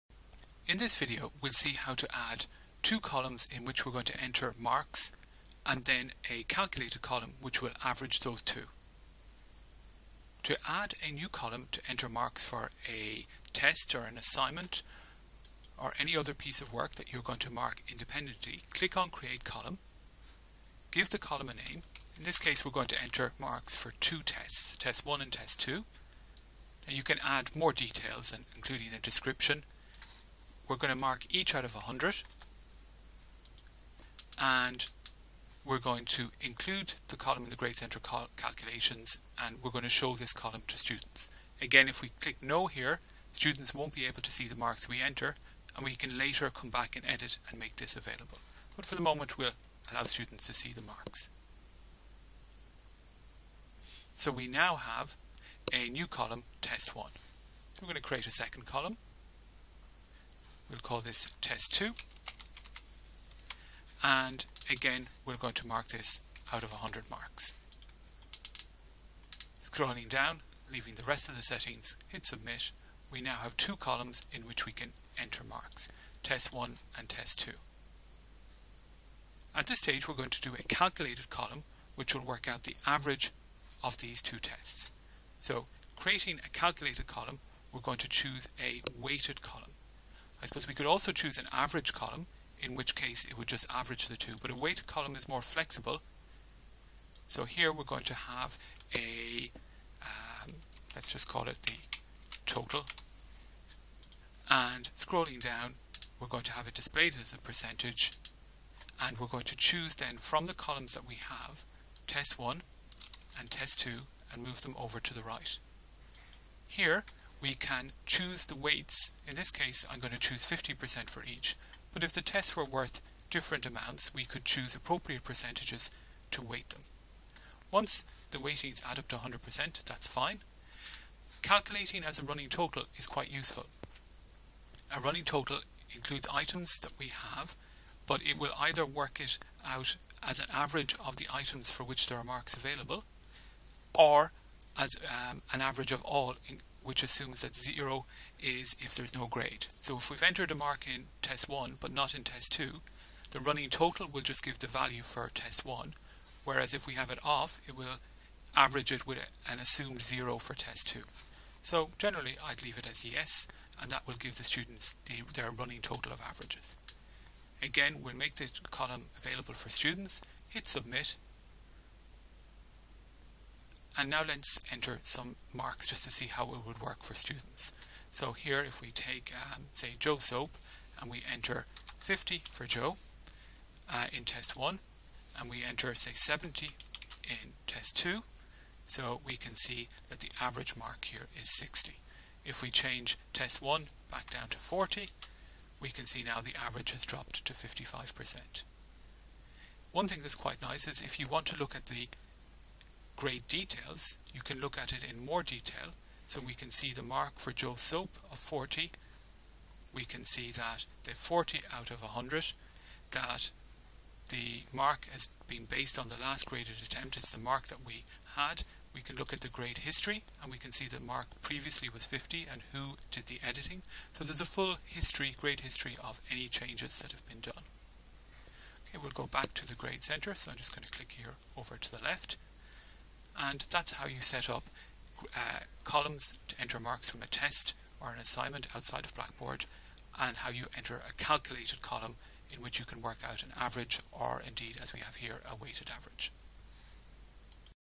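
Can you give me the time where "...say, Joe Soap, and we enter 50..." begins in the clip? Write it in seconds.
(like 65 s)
179 s.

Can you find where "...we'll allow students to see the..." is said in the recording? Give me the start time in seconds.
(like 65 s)
49 s.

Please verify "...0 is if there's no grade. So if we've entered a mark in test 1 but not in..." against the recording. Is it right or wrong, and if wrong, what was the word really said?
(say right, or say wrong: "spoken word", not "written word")
right.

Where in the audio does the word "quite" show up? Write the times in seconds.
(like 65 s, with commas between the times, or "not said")
133 s, 200 s.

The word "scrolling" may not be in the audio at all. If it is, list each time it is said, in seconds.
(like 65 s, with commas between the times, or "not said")
69 s, 104 s.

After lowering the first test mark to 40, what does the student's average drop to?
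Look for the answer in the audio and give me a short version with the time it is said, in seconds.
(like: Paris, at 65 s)
55%, at 197 s.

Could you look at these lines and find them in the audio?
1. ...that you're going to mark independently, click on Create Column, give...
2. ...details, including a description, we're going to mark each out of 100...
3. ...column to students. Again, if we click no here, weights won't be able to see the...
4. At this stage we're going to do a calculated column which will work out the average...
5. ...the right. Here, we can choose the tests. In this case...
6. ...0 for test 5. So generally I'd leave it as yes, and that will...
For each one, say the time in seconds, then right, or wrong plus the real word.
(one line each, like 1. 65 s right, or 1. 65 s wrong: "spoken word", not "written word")
1. 16 s right
2. 27 s right
3. 40 s wrong: "students", not "weights"
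4. 79 s right
5. 115 s wrong: "weights", not "tests"
6. 160 s wrong: "2", not "5".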